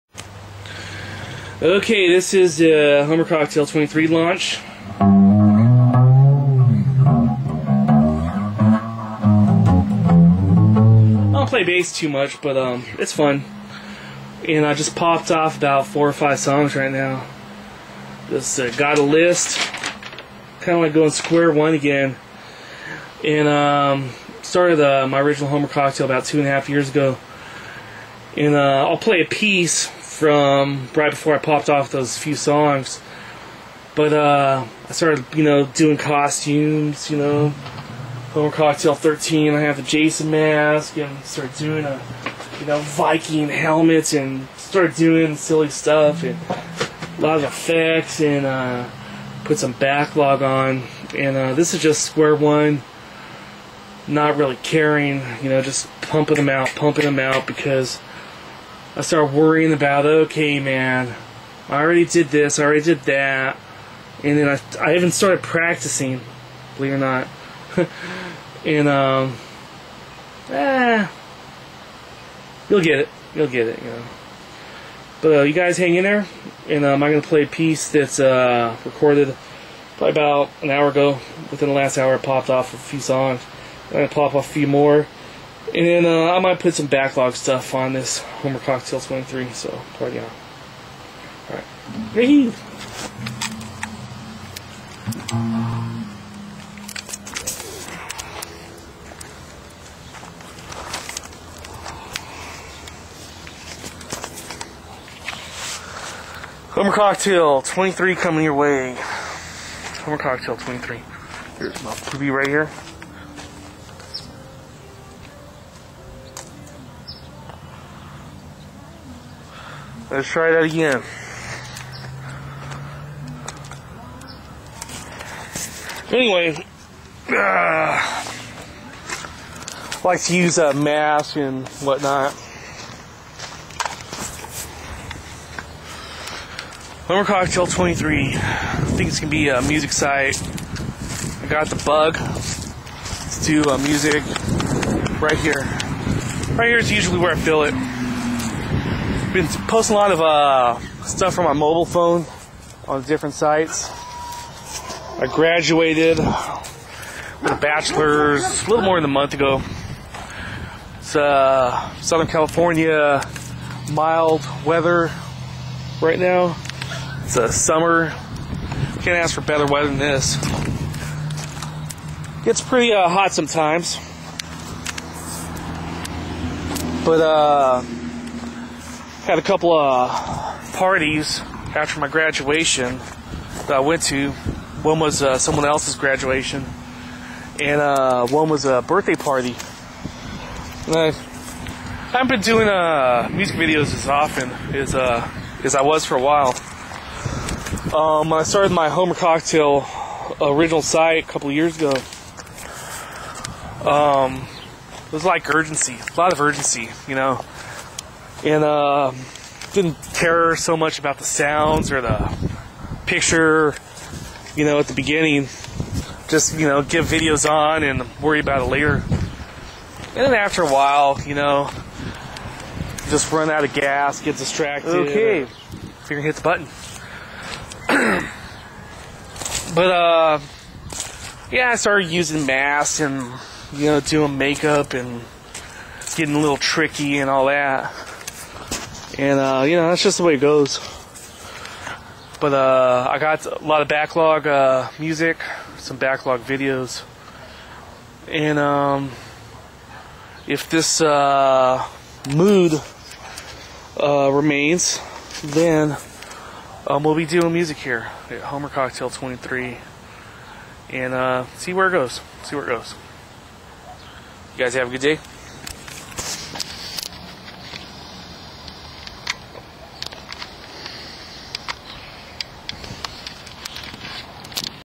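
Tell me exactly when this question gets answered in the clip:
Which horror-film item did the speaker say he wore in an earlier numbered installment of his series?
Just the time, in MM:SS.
00:39.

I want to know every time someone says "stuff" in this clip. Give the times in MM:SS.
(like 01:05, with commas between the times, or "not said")
00:45, 01:27, 02:31.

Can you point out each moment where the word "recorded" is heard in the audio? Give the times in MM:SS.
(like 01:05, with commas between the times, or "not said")
01:18.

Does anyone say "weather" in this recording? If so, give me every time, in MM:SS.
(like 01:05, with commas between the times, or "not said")
02:44, 02:49.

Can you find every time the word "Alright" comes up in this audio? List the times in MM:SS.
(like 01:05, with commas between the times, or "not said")
01:31.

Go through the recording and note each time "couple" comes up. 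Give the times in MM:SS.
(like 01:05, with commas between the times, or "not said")
02:59, 03:21.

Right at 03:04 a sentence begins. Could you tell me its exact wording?
One was uh, someone else's graduation, and uh, one was a birthday party.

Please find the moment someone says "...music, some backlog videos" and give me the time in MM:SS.
04:04.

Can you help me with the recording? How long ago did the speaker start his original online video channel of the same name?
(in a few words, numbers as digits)
2.5 years.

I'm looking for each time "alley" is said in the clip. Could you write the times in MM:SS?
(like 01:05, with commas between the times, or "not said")
not said.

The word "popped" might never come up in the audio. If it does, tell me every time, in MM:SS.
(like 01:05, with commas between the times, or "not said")
00:14, 00:31, 01:22.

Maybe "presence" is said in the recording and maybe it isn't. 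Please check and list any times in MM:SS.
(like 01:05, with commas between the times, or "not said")
not said.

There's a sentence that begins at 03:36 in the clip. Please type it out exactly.
Just, you know, get videos on and worry about it later.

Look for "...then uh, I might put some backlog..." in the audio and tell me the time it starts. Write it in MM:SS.
01:25.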